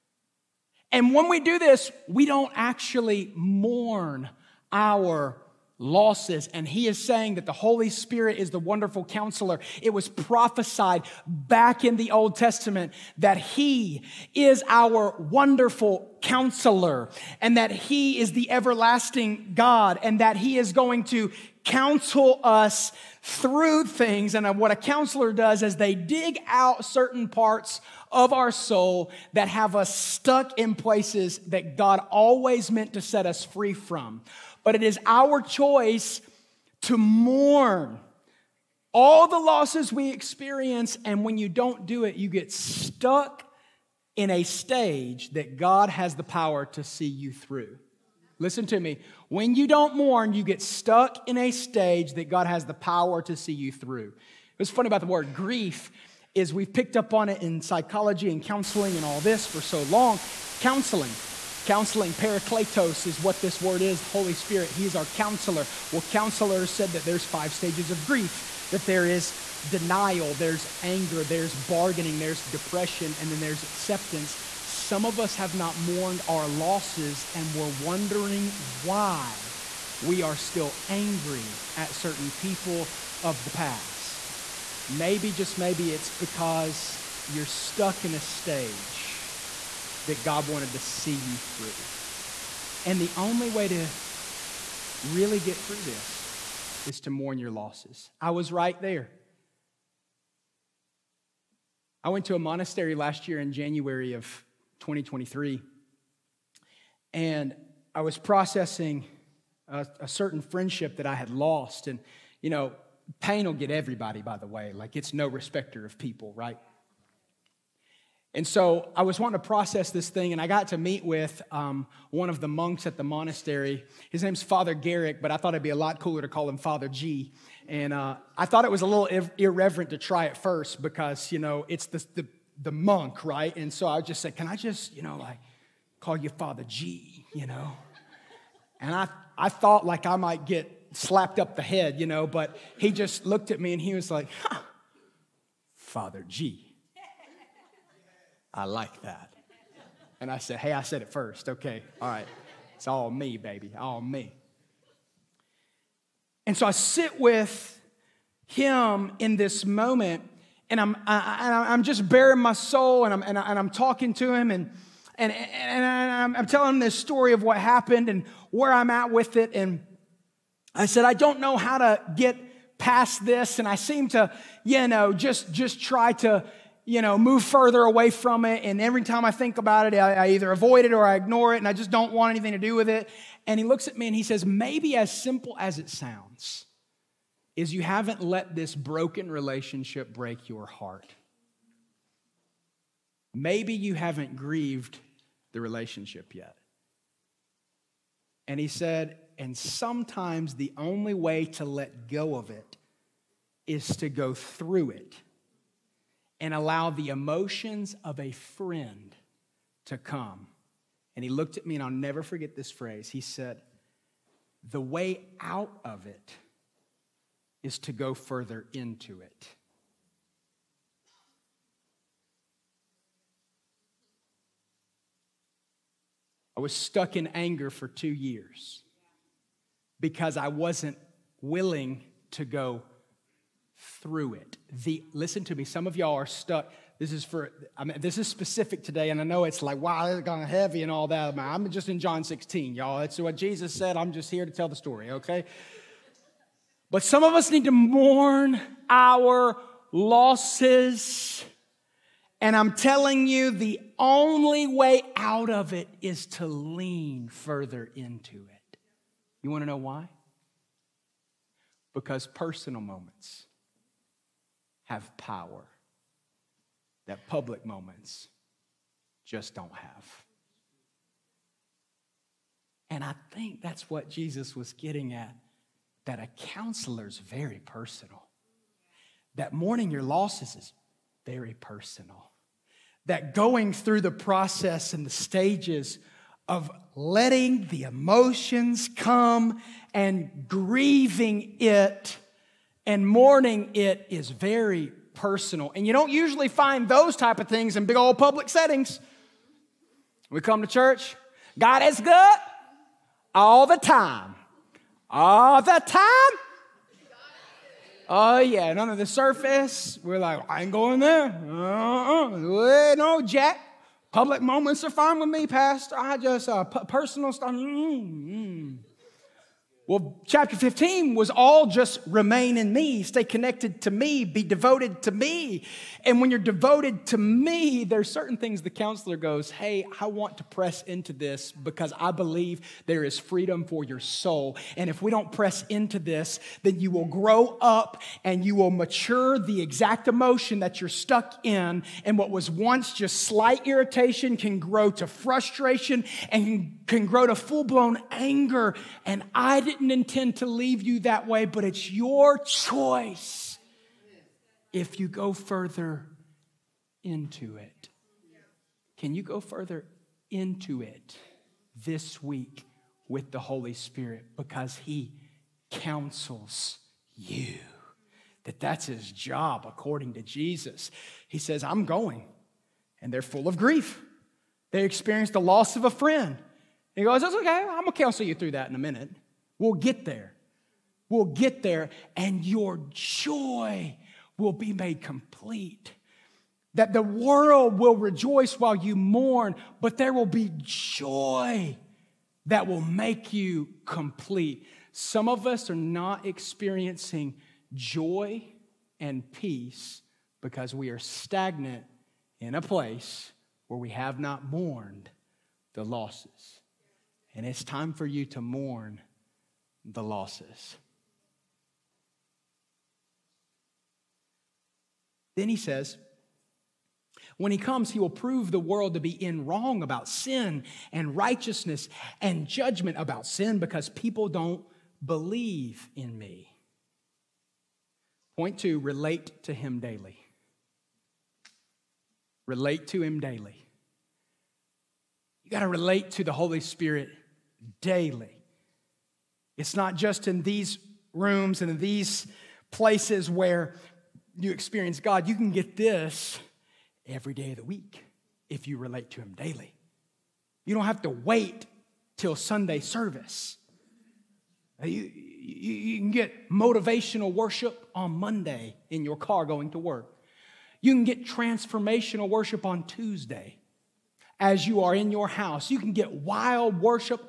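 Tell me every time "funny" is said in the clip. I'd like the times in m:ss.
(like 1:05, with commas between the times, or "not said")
0:54.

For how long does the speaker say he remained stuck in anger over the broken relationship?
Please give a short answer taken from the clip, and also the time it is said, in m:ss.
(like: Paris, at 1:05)
2 years, at 3:47.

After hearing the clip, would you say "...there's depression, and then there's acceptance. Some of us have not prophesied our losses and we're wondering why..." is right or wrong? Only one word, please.
wrong.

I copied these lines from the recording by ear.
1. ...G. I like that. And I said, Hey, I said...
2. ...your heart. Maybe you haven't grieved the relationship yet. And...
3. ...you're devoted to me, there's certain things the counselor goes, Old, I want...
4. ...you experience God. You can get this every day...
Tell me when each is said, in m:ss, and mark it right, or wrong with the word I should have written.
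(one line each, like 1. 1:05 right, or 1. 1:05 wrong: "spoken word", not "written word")
1. 2:26 right
2. 3:10 right
3. 5:26 wrong: "Hey", not "Old"
4. 7:24 right.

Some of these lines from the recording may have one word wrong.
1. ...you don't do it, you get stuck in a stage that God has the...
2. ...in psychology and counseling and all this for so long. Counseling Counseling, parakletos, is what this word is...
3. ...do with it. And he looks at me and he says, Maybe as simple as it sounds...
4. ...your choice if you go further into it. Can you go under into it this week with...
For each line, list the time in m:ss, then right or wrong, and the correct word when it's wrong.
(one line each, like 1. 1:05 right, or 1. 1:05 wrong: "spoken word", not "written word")
1. 0:41 right
2. 0:57 right
3. 3:02 right
4. 5:51 wrong: "further", not "under".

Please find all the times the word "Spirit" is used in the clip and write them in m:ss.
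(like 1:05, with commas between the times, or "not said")
0:07, 1:04, 6:03, 7:16.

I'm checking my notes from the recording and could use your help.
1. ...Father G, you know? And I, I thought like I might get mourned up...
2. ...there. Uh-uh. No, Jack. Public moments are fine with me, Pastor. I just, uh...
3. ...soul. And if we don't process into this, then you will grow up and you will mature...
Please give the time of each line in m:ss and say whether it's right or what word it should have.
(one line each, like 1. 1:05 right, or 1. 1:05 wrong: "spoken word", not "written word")
1. 2:16 wrong: "slapped", not "mourned"
2. 5:10 right
3. 5:33 wrong: "press", not "process".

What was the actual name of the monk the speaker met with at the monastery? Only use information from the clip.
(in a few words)
Father Garrick.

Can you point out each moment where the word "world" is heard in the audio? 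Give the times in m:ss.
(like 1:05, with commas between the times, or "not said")
6:27, 6:58.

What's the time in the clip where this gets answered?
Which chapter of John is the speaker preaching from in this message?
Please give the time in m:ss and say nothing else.
4:01.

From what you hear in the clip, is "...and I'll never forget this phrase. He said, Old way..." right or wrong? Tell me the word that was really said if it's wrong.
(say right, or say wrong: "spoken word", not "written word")
wrong: "The", not "Old".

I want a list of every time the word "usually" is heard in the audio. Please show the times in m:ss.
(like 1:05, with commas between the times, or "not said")
4:56.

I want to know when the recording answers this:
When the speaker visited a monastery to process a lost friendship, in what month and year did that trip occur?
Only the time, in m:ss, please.
1:43.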